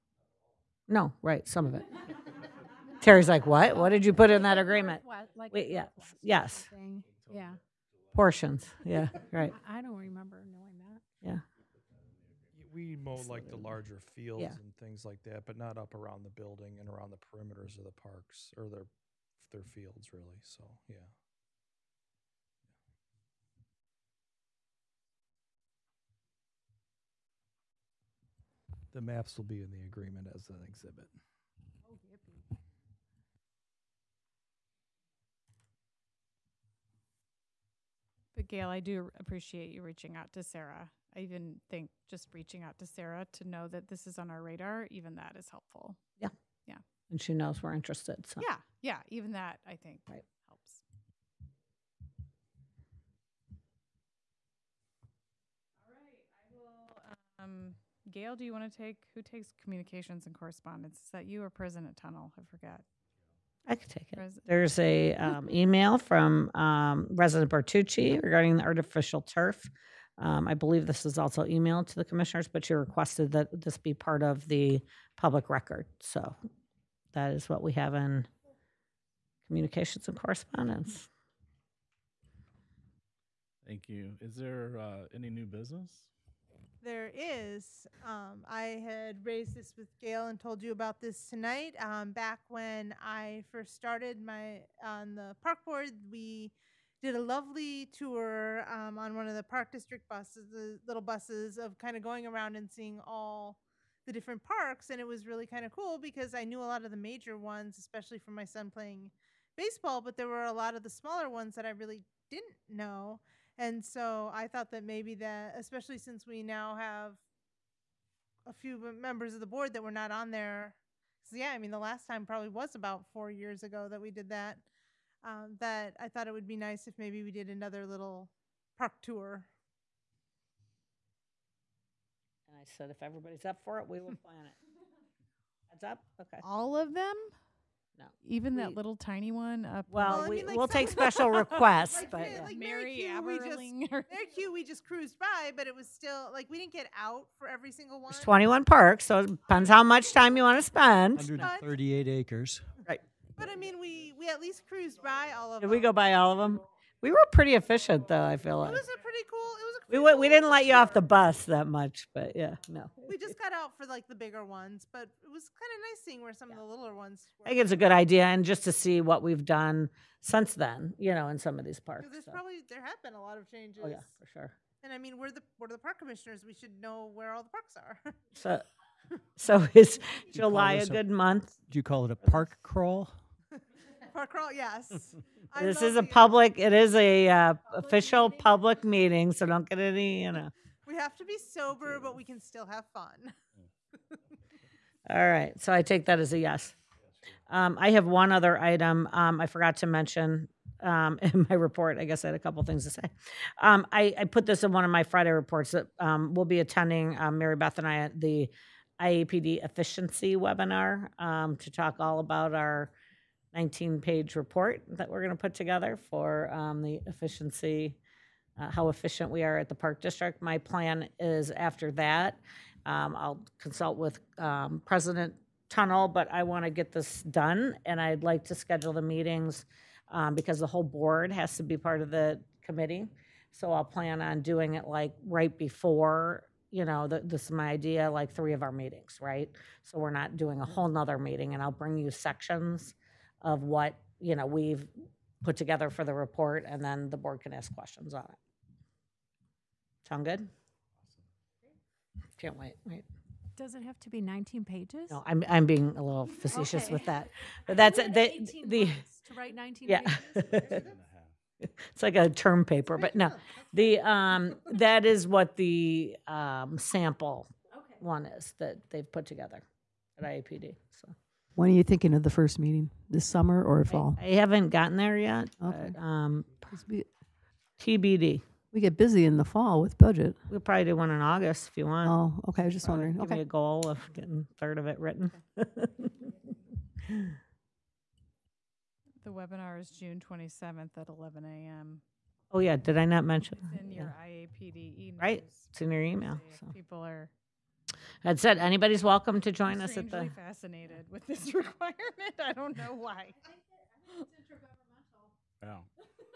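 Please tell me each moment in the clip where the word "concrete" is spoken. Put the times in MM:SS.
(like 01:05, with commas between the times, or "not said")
not said.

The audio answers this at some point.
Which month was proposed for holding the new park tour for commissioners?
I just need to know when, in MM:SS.
03:00.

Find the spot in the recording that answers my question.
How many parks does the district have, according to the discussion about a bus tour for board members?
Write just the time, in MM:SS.
02:28.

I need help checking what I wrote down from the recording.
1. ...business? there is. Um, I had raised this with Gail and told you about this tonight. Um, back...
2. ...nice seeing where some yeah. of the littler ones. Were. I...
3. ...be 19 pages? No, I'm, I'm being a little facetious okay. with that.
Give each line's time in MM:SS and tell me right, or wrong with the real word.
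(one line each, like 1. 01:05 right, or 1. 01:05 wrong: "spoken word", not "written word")
1. 01:25 right
2. 02:45 right
3. 04:14 right.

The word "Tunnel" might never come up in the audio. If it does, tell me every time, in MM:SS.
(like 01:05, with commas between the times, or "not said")
01:01, 03:45.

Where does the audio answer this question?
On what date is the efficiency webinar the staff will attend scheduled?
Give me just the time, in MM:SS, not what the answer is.
04:49.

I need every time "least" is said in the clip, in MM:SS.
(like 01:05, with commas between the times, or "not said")
02:34.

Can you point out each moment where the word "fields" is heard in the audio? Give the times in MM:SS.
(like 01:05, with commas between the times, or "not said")
00:14, 00:19.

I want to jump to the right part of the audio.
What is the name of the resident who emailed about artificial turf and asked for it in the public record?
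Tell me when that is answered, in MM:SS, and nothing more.
01:07.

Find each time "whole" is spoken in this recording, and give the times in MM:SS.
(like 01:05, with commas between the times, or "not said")
03:50, 04:00.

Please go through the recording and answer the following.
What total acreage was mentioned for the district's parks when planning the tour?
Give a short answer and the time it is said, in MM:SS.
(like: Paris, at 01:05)
138 acres, at 02:31.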